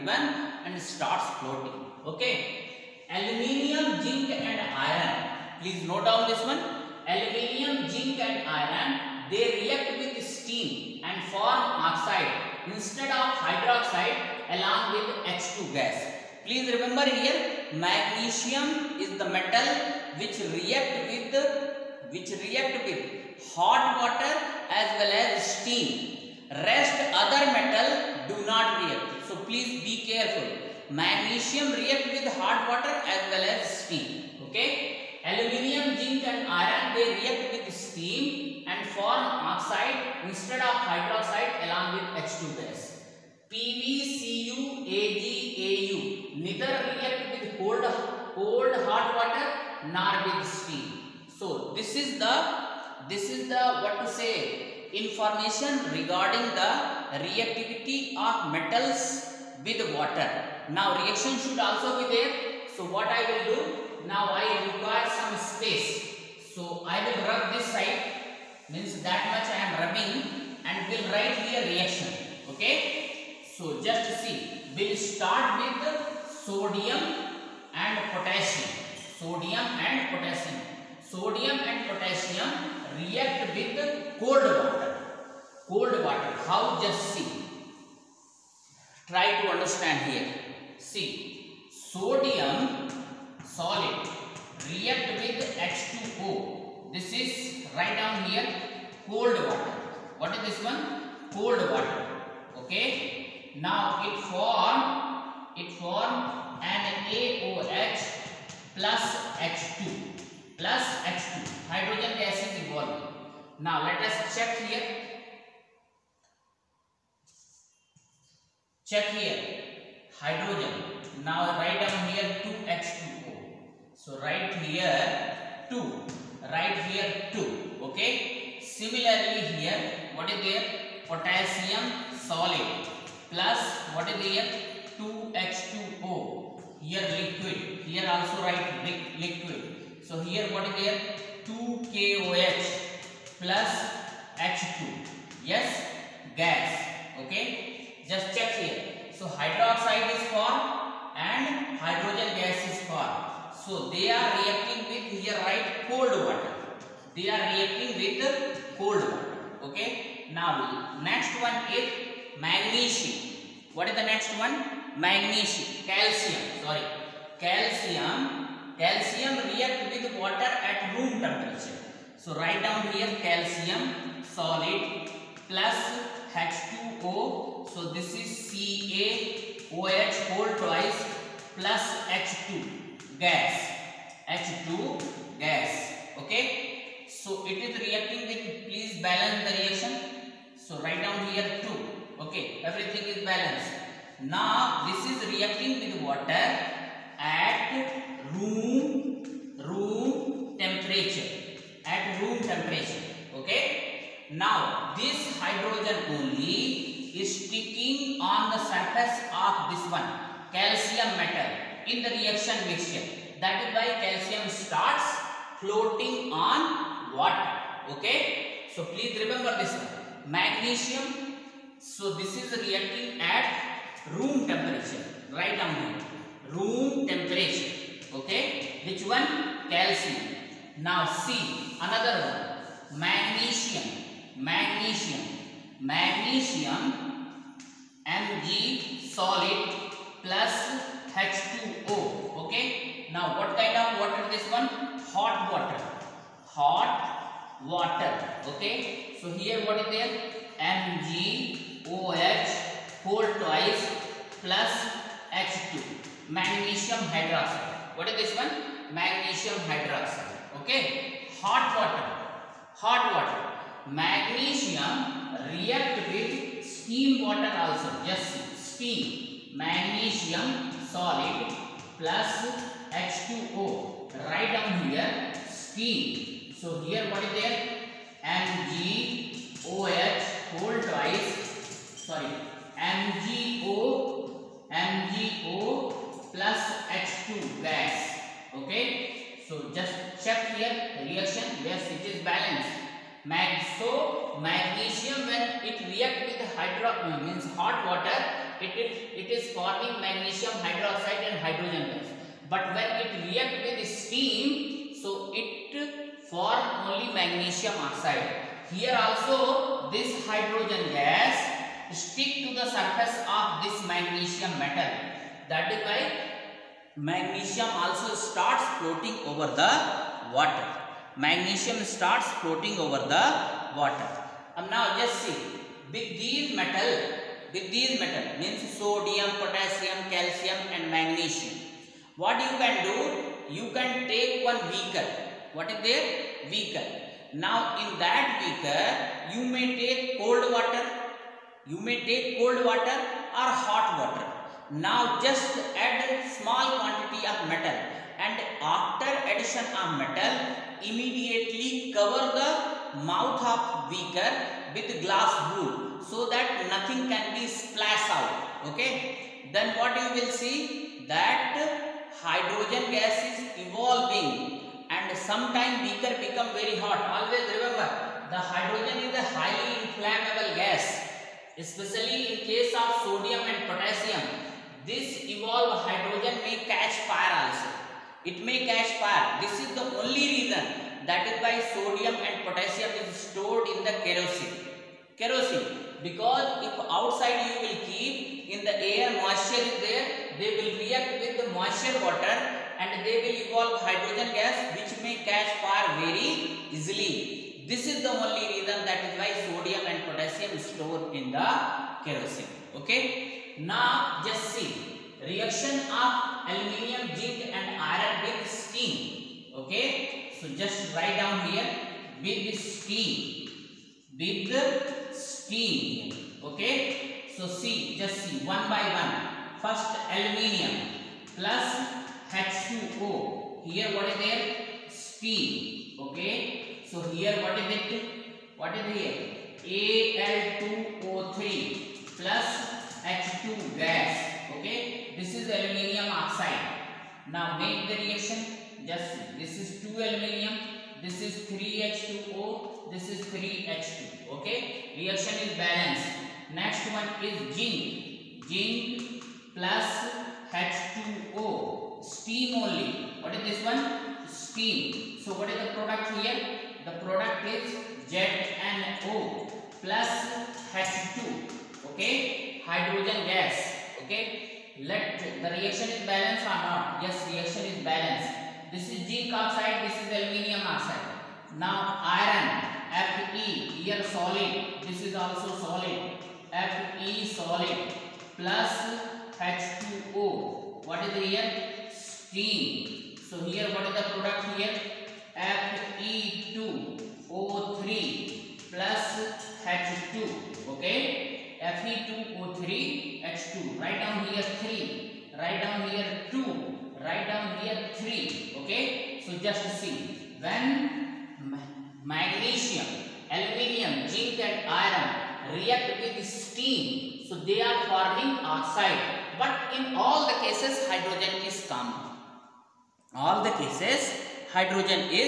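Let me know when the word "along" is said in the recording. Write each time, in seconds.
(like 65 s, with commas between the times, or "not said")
14 s, 41 s.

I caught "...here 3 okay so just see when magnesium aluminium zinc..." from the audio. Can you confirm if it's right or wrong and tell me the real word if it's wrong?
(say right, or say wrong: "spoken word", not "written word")
right.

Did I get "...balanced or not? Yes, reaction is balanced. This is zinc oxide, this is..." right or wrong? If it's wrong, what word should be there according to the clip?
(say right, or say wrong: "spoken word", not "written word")
right.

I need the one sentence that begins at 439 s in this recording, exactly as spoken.
this is 2 aluminium this is 3H2O, this is 3H2.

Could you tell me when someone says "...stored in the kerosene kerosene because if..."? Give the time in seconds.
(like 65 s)
383 s.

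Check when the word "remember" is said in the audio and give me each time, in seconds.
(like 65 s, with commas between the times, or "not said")
16 s, 219 s, 367 s.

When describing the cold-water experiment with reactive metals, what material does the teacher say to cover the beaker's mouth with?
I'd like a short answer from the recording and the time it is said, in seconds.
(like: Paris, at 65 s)
Glass wool, at 355 s.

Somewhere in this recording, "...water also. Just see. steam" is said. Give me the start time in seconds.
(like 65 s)
267 s.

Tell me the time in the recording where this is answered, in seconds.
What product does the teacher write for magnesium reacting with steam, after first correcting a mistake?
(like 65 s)
282 s.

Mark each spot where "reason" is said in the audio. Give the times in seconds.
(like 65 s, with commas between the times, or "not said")
380 s, 398 s.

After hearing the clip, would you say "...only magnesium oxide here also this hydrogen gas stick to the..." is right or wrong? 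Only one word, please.
right.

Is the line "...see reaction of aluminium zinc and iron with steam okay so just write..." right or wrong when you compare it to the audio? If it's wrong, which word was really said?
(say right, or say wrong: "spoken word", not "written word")
right.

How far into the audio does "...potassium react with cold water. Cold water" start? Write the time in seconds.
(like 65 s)
81 s.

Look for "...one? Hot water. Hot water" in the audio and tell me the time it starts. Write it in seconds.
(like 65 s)
244 s.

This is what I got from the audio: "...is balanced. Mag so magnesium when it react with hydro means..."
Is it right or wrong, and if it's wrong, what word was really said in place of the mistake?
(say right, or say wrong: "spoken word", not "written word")
right.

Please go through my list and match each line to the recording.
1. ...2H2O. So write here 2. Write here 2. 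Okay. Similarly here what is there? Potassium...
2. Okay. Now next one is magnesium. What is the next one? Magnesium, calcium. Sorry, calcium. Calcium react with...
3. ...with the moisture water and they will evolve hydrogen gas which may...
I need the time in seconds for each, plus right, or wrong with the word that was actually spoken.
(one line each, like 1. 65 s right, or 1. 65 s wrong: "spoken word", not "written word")
1. 122 s right
2. 159 s right
3. 391 s right.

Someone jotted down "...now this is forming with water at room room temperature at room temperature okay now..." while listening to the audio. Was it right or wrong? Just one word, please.
wrong.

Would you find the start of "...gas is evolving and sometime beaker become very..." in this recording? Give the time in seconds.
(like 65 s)
362 s.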